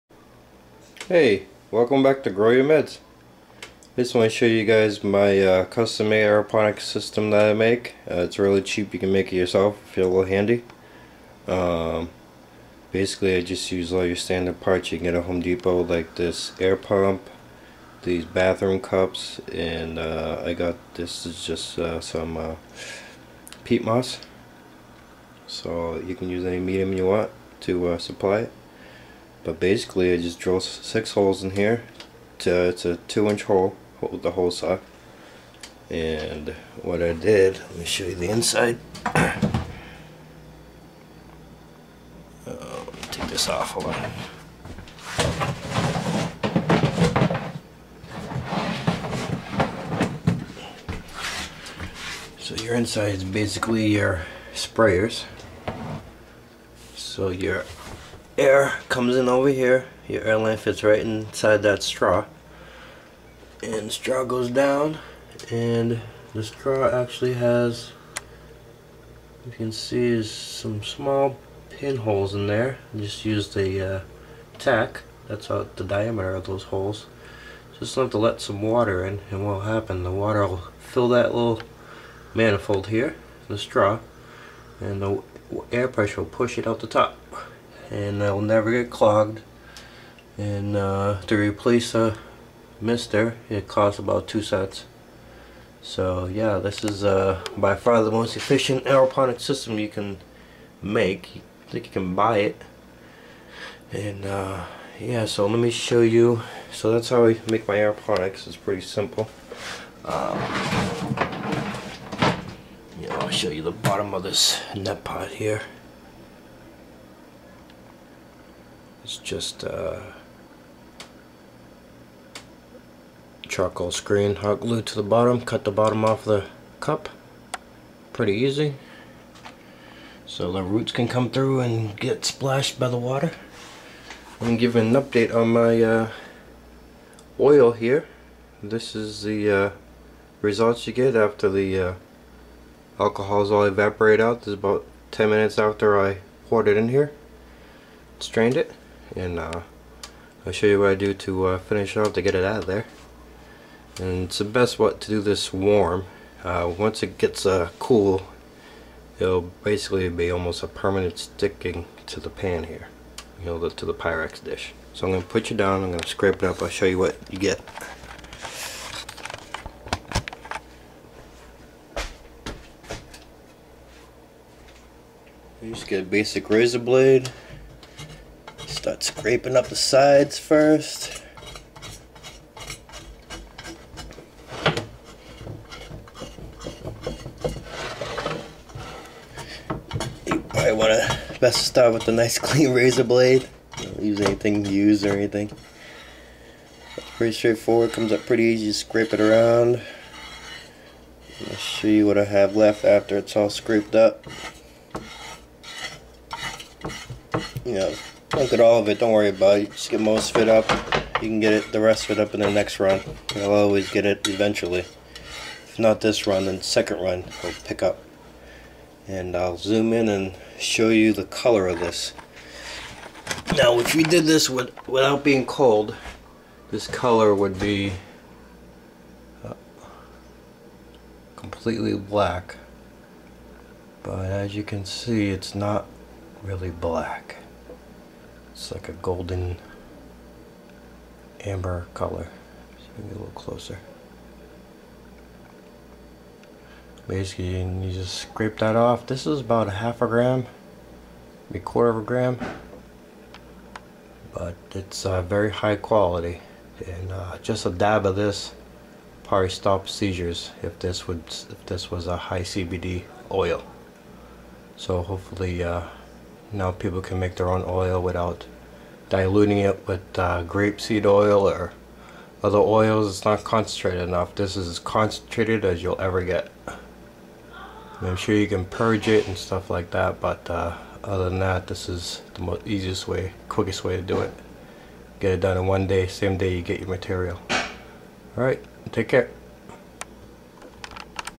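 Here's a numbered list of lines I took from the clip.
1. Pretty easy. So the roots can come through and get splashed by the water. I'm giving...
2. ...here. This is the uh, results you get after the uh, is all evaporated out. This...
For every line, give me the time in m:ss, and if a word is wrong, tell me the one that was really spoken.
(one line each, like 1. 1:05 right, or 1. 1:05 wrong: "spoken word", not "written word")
1. 2:08 right
2. 2:17 right.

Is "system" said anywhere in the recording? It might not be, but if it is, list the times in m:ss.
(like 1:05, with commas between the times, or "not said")
0:06, 1:39.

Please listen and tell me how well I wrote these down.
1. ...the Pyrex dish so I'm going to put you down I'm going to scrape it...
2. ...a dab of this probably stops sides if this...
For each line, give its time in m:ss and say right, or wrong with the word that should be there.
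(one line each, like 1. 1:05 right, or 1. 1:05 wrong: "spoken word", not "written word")
1. 2:43 right
2. 4:17 wrong: "seizures", not "sides".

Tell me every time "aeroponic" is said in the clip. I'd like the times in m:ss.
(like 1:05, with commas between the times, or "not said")
0:06, 1:38, 1:47.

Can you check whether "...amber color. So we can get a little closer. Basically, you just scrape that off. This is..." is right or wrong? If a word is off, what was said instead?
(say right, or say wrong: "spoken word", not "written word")
right.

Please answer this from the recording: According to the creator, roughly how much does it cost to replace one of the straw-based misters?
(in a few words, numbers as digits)
2 cents.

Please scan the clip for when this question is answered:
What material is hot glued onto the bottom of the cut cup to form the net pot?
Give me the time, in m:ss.
2:03.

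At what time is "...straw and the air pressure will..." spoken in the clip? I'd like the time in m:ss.
1:23.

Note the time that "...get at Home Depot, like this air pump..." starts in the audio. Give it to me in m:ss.
0:15.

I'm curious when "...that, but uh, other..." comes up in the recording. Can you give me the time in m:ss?
4:39.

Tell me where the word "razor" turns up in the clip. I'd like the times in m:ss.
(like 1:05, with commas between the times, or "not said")
2:56, 3:12.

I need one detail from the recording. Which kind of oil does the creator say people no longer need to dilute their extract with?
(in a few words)
grapeseed oil.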